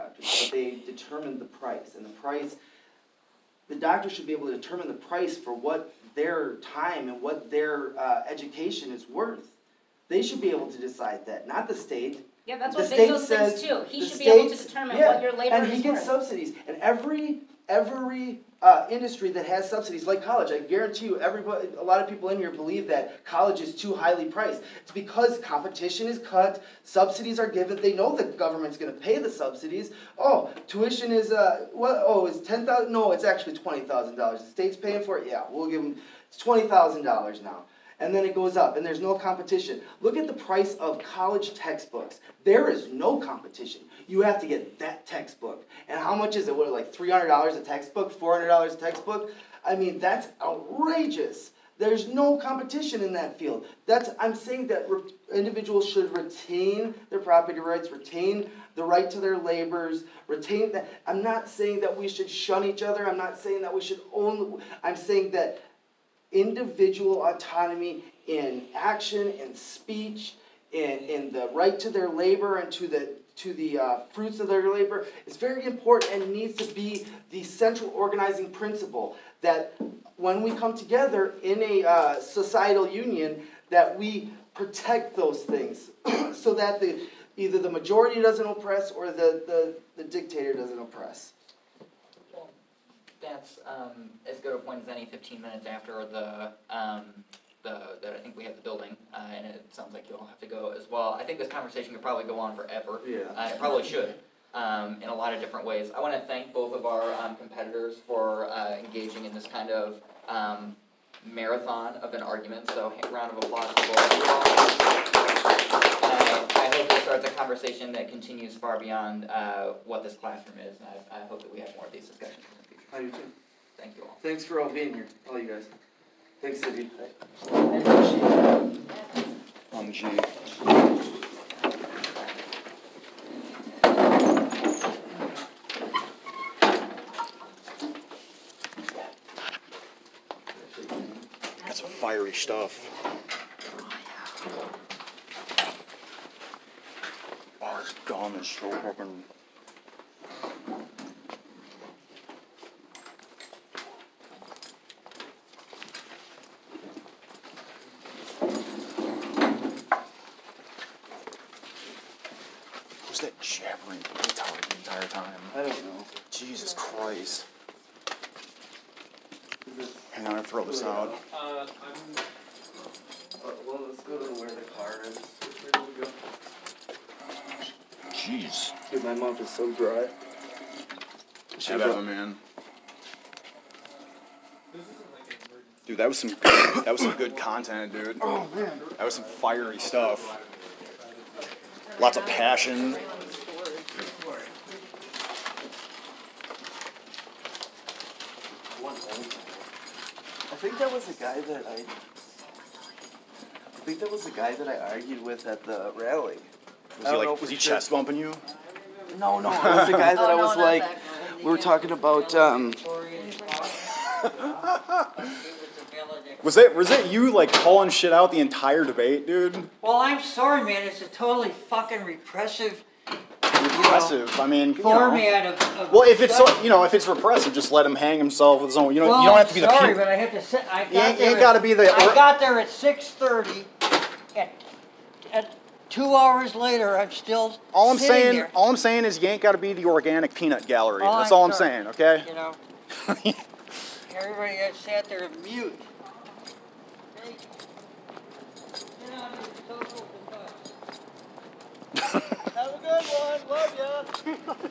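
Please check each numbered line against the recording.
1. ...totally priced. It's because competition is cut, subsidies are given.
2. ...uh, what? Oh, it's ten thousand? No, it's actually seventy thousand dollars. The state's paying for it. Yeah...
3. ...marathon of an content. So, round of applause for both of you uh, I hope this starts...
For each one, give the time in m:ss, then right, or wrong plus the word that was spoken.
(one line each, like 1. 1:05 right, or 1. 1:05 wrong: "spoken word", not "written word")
1. 0:23 wrong: "highly", not "totally"
2. 0:31 wrong: "twenty", not "seventy"
3. 1:51 wrong: "argument", not "content".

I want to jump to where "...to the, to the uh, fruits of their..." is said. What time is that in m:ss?
1:12.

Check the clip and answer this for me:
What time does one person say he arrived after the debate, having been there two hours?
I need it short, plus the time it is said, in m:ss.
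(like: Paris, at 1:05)
6:30, at 3:52.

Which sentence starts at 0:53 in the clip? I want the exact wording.
That's, I'm saying that individuals should retain their property rights, retain the right to their labors, retain that.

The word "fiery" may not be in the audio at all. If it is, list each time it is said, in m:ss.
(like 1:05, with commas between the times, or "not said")
2:21, 3:09.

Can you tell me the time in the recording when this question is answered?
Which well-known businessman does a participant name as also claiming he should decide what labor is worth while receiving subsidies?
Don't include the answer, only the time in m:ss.
0:13.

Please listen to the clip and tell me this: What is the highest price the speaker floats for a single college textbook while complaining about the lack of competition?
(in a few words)
$400.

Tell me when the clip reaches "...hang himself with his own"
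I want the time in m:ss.
3:47.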